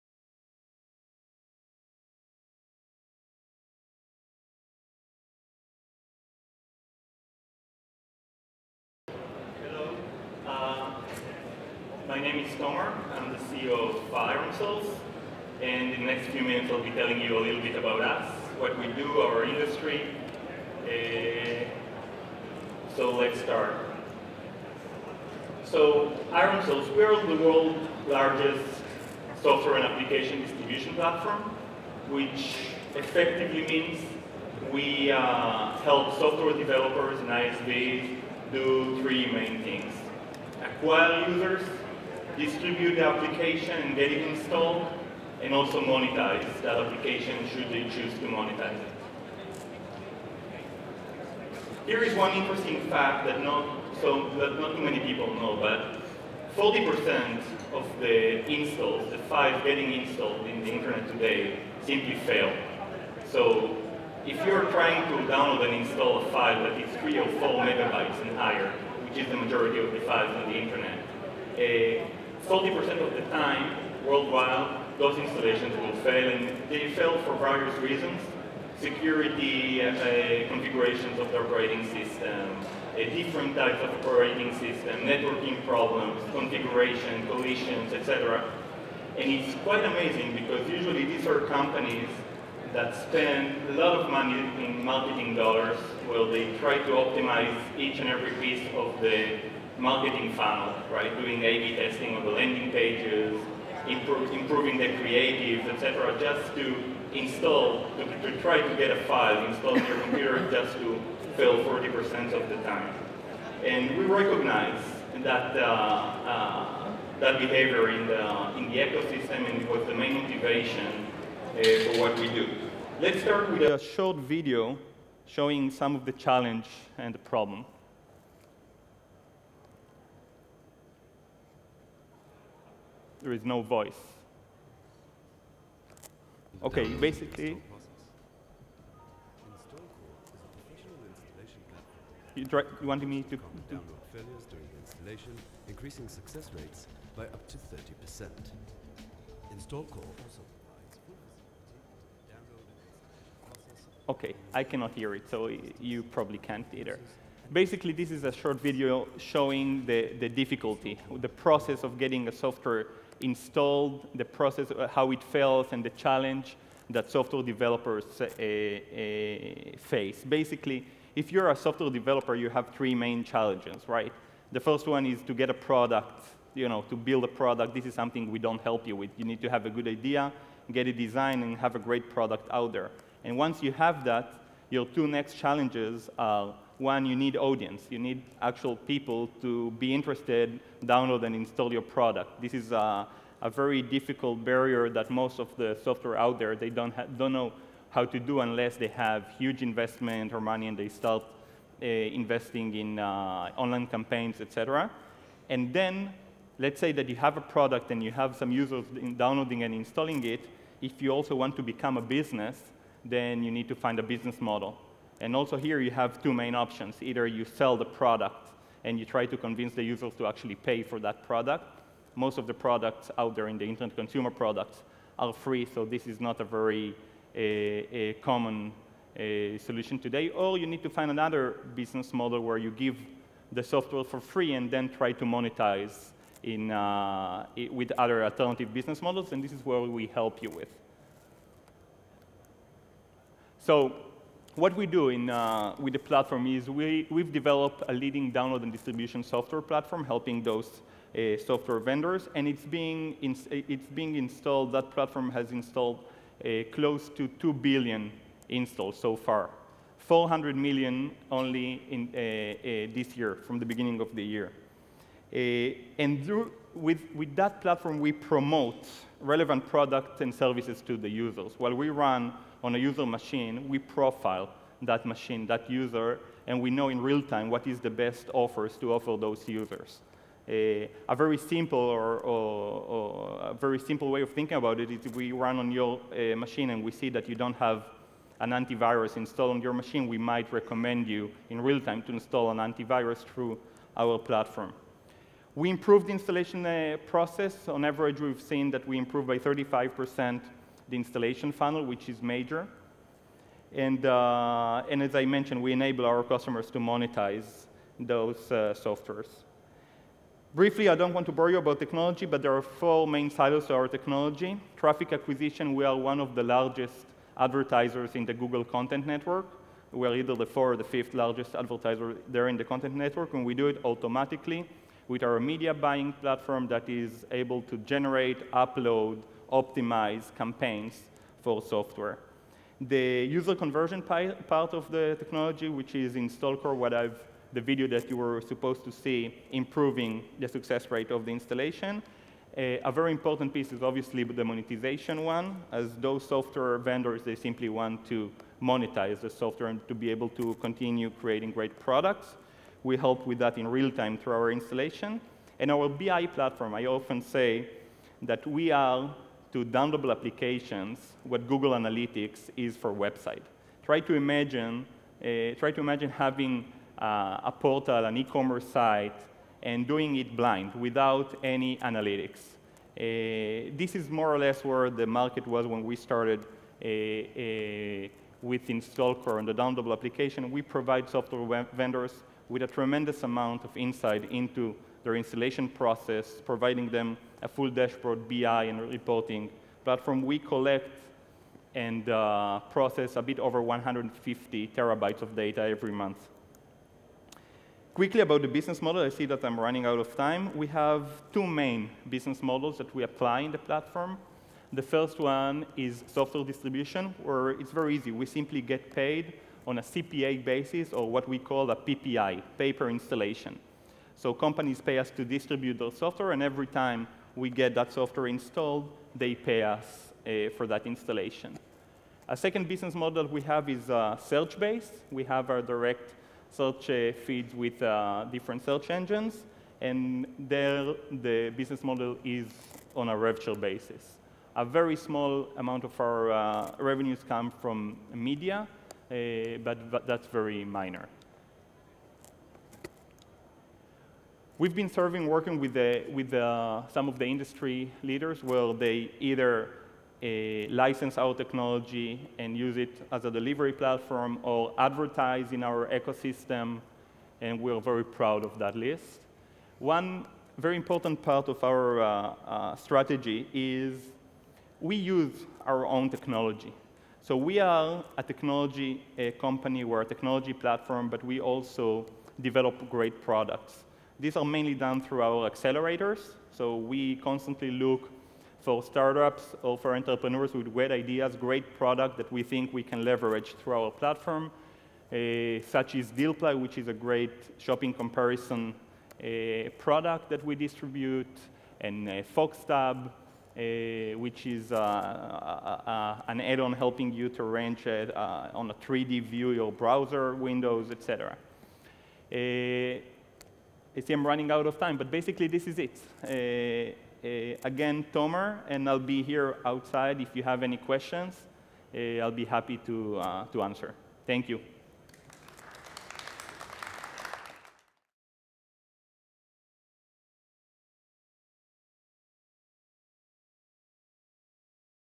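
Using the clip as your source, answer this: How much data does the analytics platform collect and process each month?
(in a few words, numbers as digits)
150 terabytes.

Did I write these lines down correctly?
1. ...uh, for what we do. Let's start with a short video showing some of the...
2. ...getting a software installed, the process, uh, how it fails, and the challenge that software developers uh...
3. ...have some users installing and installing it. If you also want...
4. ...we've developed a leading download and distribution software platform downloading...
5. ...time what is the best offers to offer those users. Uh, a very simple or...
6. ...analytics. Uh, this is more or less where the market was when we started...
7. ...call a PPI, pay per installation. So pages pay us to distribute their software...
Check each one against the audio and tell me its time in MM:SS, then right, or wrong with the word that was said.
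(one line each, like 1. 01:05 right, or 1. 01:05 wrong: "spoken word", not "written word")
1. 02:01 right
2. 02:41 right
3. 03:28 wrong: "downloading", not "installing"
4. 04:07 wrong: "helping", not "downloading"
5. 04:37 right
6. 06:11 right
7. 06:51 wrong: "companies", not "pages".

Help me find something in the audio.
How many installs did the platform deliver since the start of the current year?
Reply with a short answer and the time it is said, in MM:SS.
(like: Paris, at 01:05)
400 million, at 04:19.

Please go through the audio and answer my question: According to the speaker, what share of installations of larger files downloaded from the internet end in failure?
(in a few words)
40%.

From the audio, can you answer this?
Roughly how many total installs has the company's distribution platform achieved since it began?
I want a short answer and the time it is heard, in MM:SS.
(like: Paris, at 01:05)
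close to 2 billion, at 04:16.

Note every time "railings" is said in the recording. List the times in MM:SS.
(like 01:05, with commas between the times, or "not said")
not said.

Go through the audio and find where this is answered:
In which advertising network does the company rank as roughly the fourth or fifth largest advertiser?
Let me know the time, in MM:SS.
05:18.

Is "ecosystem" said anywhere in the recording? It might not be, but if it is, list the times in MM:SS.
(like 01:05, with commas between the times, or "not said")
01:58, 07:35.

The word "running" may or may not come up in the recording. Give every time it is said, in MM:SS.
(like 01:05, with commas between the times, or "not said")
06:39, 08:24.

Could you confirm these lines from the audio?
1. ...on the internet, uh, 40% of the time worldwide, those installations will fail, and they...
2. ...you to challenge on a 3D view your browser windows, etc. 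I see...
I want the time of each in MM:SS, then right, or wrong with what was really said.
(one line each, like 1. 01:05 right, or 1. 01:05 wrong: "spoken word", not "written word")
1. 01:10 right
2. 08:17 wrong: "arrange", not "challenge".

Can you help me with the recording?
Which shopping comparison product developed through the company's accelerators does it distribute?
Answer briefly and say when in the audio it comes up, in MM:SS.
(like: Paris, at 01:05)
DealPly, at 08:06.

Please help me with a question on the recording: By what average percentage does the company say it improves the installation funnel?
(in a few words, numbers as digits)
35 percent.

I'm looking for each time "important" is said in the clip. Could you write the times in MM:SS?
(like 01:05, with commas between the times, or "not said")
05:43, 07:40.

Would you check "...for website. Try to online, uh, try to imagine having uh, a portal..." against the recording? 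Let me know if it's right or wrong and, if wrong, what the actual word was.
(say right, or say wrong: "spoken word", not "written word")
wrong: "imagine", not "online".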